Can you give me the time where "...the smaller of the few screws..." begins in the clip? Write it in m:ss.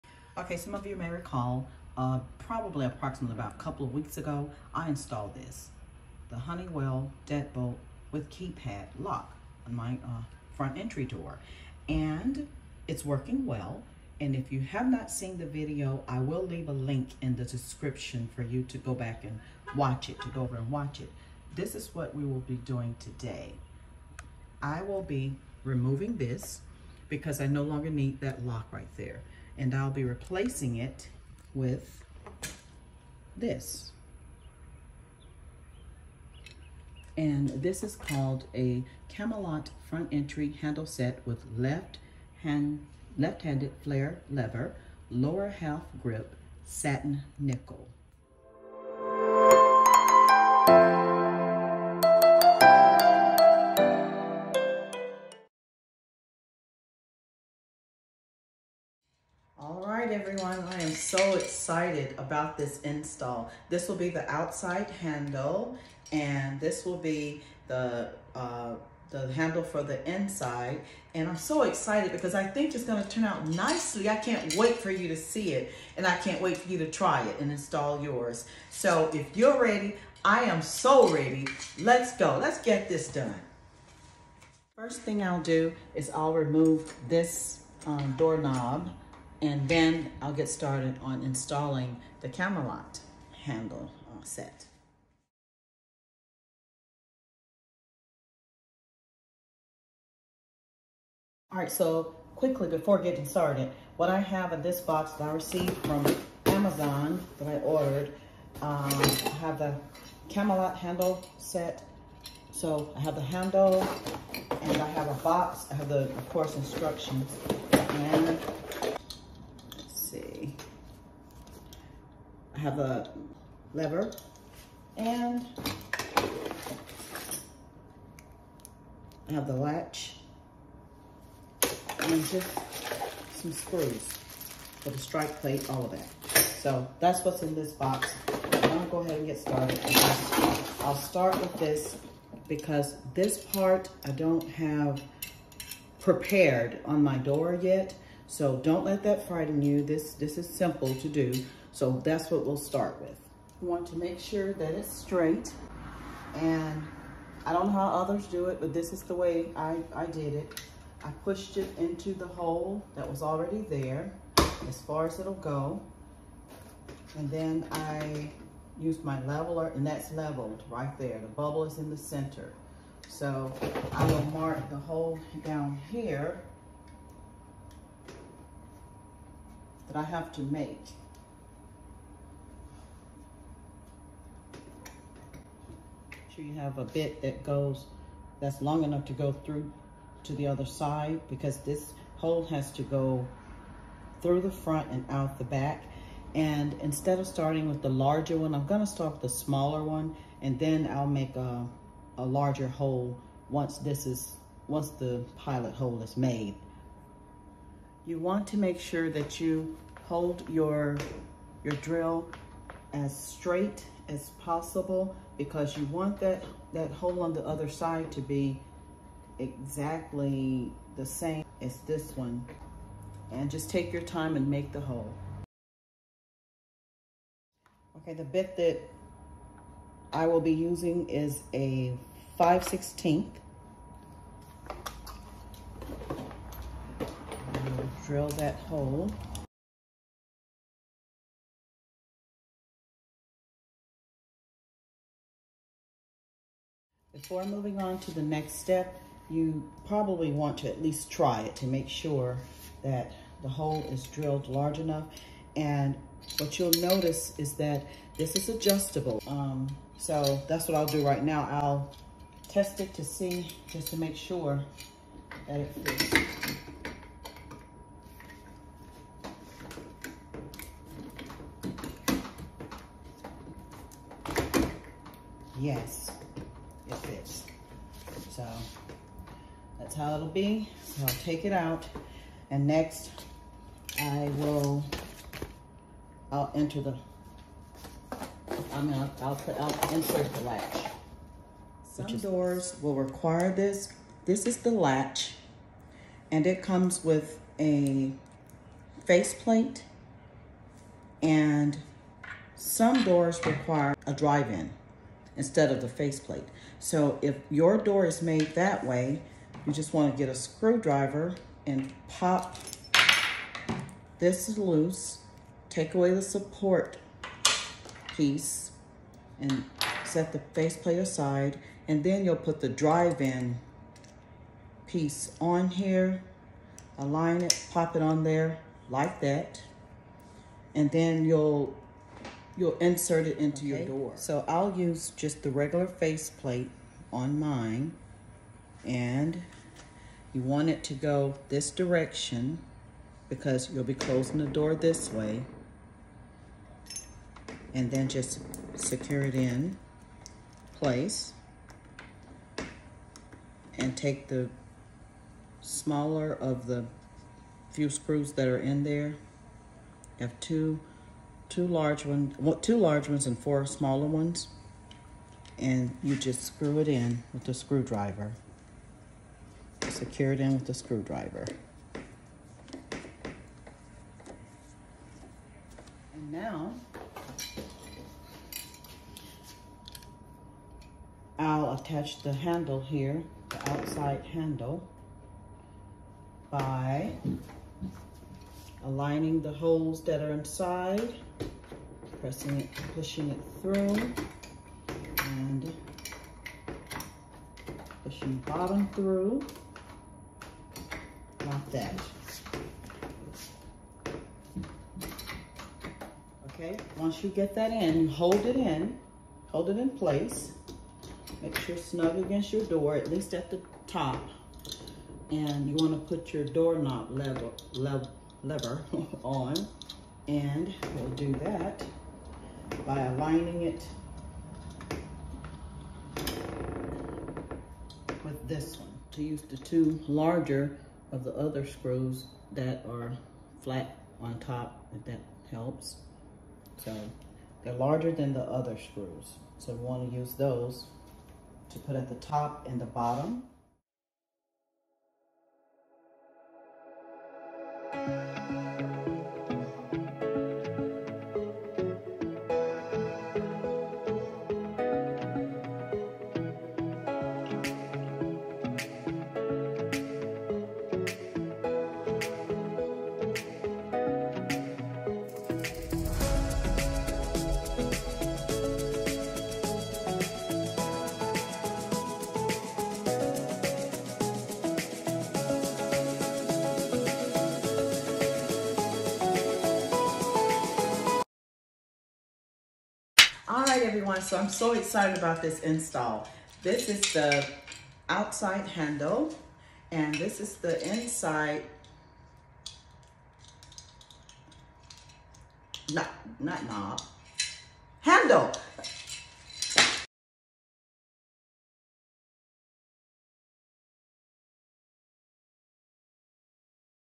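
5:54.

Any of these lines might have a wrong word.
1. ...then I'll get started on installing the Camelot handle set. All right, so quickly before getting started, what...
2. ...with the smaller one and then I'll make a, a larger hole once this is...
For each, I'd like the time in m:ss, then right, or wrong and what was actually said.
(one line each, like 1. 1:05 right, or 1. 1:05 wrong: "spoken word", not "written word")
1. 1:29 right
2. 3:19 right.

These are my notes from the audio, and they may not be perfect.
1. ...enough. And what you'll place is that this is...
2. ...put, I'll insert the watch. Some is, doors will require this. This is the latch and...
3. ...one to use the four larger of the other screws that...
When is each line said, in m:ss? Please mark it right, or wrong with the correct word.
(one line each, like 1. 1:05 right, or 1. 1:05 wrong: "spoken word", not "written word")
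1. 4:14 wrong: "notice", not "place"
2. 4:49 wrong: "latch", not "watch"
3. 7:08 wrong: "two", not "four".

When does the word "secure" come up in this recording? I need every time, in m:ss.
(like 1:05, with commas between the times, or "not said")
5:48, 6:09.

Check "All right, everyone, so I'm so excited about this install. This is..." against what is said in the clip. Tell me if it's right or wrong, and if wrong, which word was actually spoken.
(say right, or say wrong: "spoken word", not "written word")
right.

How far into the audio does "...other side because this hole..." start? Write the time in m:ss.
3:10.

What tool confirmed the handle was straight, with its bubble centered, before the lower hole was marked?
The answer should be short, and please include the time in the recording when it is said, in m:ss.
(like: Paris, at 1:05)
Leveler, at 2:49.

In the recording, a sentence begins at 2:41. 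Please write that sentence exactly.
I pushed it into the hole that was already there as far as it'll go.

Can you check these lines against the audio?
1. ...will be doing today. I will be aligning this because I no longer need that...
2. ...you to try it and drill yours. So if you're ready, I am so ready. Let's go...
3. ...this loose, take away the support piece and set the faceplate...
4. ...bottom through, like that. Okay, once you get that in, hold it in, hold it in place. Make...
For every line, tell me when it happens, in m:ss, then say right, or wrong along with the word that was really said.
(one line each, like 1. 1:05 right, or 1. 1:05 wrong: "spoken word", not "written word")
1. 0:22 wrong: "removing", not "aligning"
2. 1:16 wrong: "install", not "drill"
3. 5:14 right
4. 6:38 right.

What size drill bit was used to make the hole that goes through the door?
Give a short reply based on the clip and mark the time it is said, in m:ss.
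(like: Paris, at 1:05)
5/16, at 3:52.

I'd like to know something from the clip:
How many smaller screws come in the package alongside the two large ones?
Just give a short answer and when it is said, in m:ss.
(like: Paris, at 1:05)
4, at 6:03.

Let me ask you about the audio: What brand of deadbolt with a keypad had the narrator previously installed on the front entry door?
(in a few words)
Honeywell.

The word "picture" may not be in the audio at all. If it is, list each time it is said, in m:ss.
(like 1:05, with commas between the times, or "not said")
not said.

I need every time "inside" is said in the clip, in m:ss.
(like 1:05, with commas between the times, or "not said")
1:10, 6:30, 8:10.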